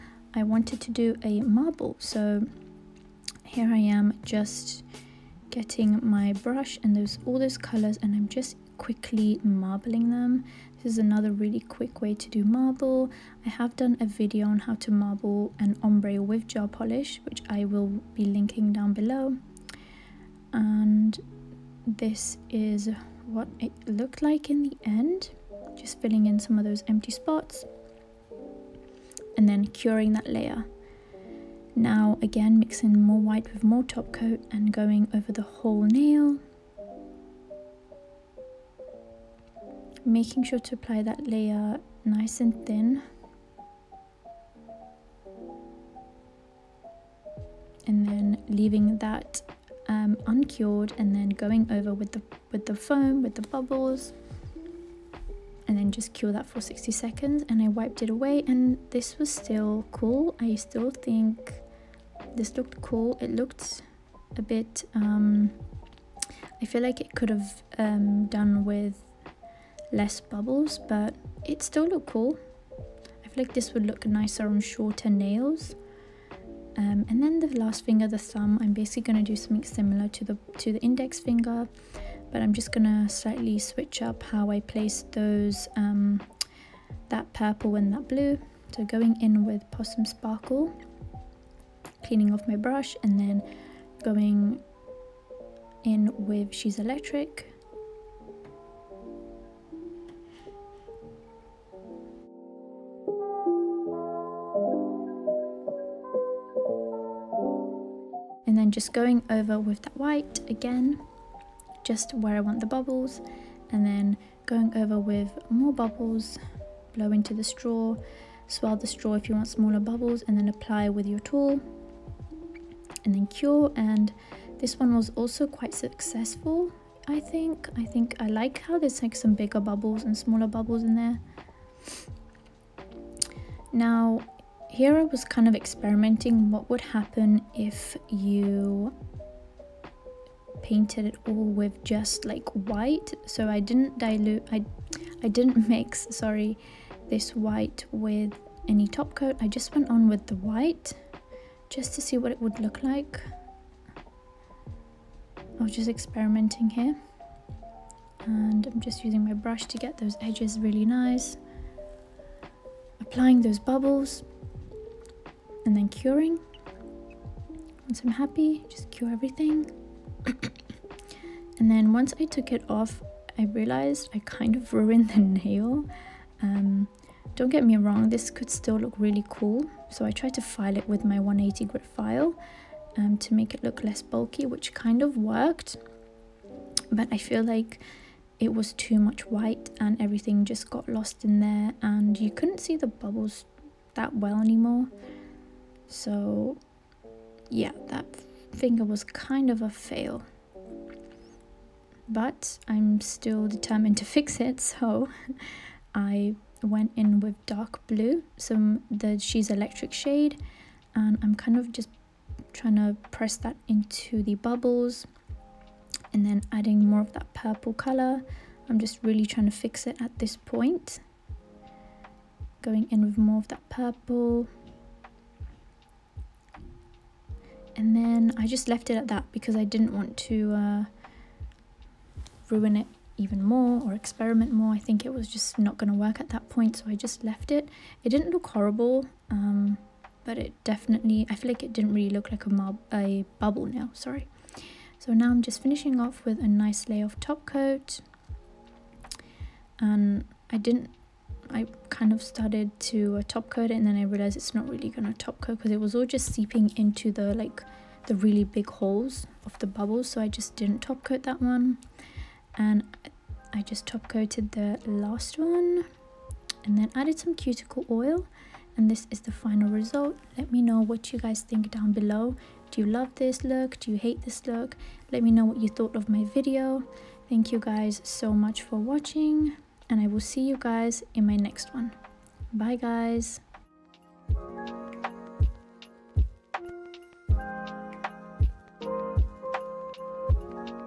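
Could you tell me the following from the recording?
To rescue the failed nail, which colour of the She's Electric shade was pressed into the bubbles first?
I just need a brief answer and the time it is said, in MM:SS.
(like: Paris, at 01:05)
dark blue, at 03:27.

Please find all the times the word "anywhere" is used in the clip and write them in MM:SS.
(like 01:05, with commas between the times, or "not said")
not said.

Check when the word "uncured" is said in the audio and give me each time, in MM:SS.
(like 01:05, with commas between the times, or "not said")
00:50.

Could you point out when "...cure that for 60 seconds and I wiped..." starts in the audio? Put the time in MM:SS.
00:56.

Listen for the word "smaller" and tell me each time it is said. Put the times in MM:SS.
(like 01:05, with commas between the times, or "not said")
01:59, 02:10.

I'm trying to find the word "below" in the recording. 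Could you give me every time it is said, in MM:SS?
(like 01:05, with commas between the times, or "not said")
00:18, 04:31.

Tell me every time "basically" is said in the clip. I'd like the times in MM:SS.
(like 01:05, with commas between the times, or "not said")
01:18.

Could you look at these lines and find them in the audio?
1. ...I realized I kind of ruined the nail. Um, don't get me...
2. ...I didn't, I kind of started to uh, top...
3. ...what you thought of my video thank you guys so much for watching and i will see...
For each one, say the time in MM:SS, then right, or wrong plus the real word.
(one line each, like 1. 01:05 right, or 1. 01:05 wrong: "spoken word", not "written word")
1. 02:53 right
2. 04:10 right
3. 04:35 right.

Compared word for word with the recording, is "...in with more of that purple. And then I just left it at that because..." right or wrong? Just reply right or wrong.
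right.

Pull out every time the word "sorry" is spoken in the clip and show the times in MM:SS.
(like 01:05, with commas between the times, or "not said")
02:26, 04:03.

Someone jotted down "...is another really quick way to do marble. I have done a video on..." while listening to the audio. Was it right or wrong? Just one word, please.
right.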